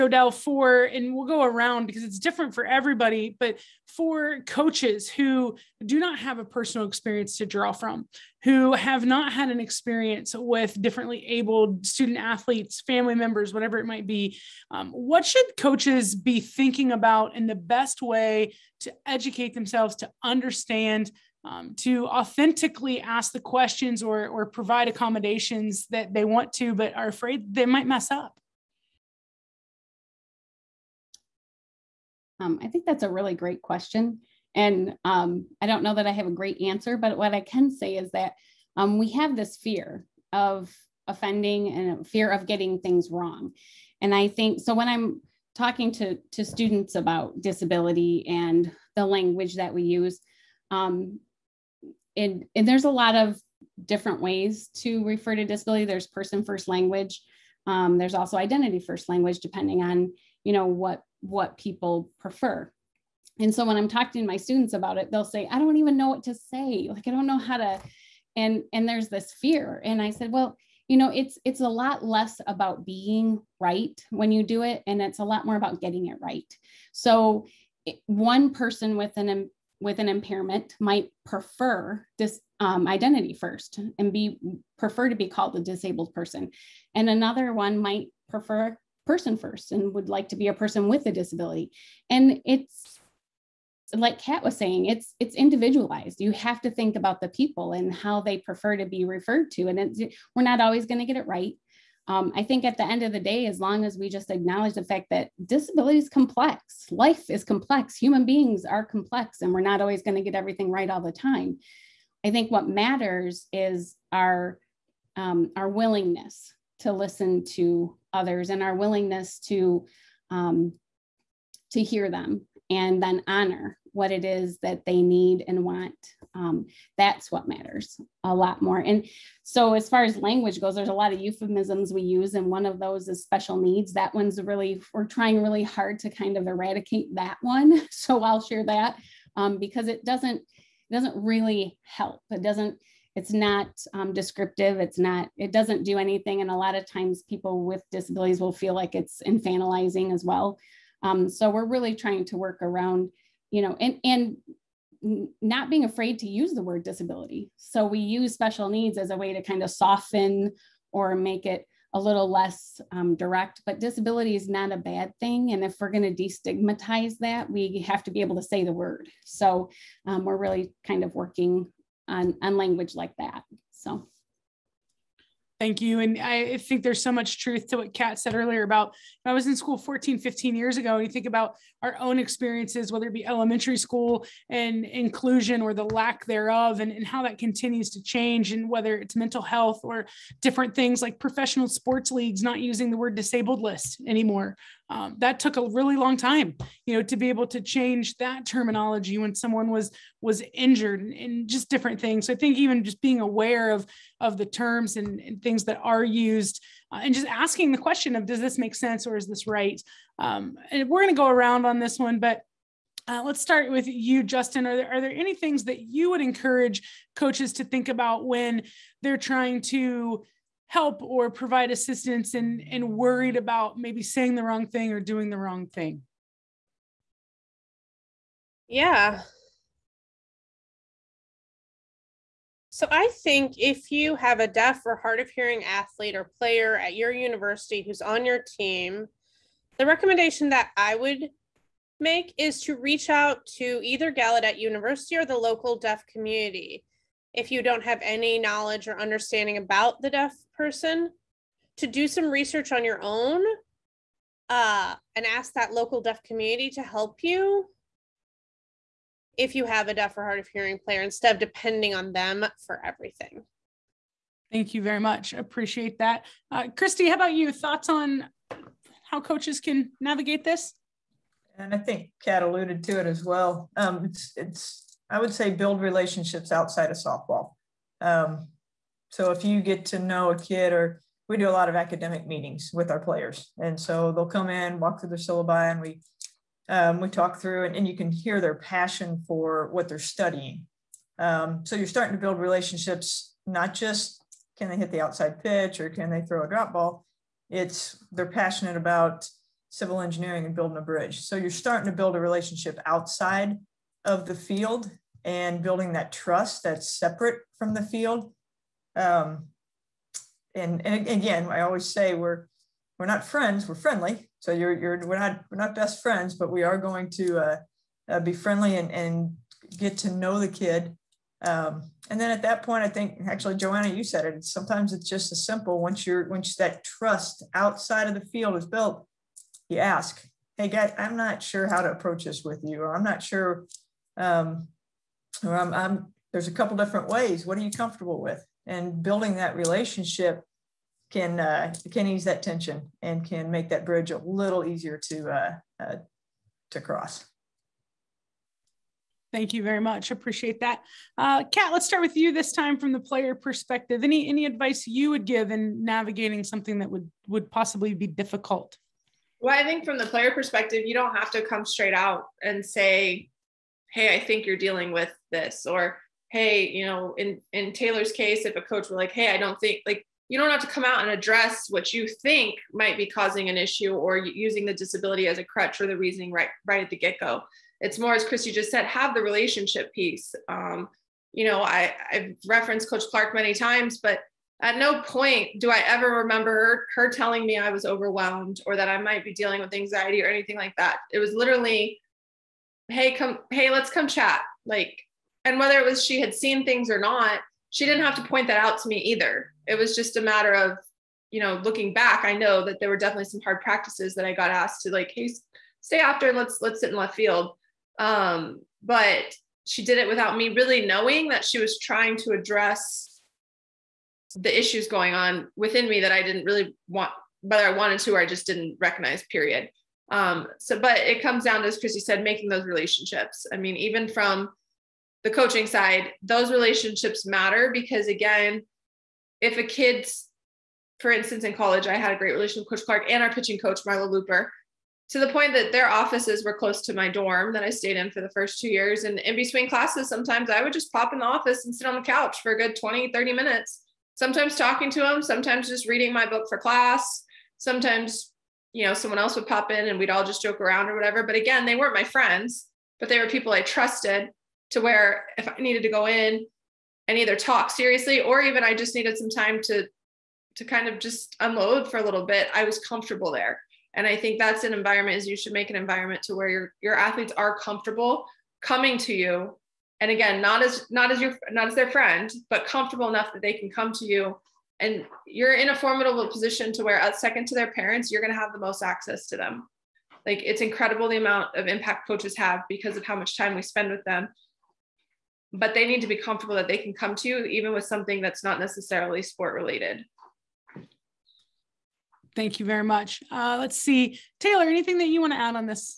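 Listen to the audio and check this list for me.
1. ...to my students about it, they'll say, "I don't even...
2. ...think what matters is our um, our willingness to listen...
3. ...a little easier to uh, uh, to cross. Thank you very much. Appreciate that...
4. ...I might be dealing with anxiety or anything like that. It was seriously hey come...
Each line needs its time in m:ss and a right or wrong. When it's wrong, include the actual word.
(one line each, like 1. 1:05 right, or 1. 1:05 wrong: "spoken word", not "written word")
1. 1:04 right
2. 1:52 right
3. 5:44 right
4. 6:28 wrong: "literally", not "seriously".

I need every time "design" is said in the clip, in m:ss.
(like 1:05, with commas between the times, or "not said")
not said.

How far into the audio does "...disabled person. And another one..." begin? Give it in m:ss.
1:25.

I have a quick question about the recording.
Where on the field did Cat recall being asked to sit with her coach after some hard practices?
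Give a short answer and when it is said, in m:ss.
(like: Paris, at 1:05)
left field, at 6:46.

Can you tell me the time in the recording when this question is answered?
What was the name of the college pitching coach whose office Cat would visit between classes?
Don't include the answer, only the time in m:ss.
7:13.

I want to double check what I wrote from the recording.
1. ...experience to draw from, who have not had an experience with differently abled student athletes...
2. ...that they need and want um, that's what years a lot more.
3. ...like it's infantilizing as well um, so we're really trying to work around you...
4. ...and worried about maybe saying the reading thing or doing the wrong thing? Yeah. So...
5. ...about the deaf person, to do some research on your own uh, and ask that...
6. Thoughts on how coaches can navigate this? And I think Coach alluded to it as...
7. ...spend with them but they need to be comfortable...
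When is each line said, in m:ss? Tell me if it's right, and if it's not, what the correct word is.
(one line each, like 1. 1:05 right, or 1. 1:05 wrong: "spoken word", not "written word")
1. 0:06 right
2. 2:04 wrong: "matters", not "years"
3. 2:28 right
4. 3:42 wrong: "wrong", not "reading"
5. 4:09 right
6. 4:27 wrong: "Cat", not "Coach"
7. 8:03 right.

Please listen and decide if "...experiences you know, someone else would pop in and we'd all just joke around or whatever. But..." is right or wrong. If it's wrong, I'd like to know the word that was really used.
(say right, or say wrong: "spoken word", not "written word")
wrong: "sometimes", not "experiences".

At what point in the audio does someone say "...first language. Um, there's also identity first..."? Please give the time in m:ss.
0:56.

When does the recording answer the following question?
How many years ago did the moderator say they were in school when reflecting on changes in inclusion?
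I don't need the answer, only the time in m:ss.
2:59.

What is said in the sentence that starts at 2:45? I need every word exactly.
And if we're going to destigmatize that, we have to be able to say the word.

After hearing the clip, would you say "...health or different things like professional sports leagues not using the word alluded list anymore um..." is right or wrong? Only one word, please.
wrong.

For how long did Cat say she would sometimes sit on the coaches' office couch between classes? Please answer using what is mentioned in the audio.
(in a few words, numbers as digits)
20, 30 minutes.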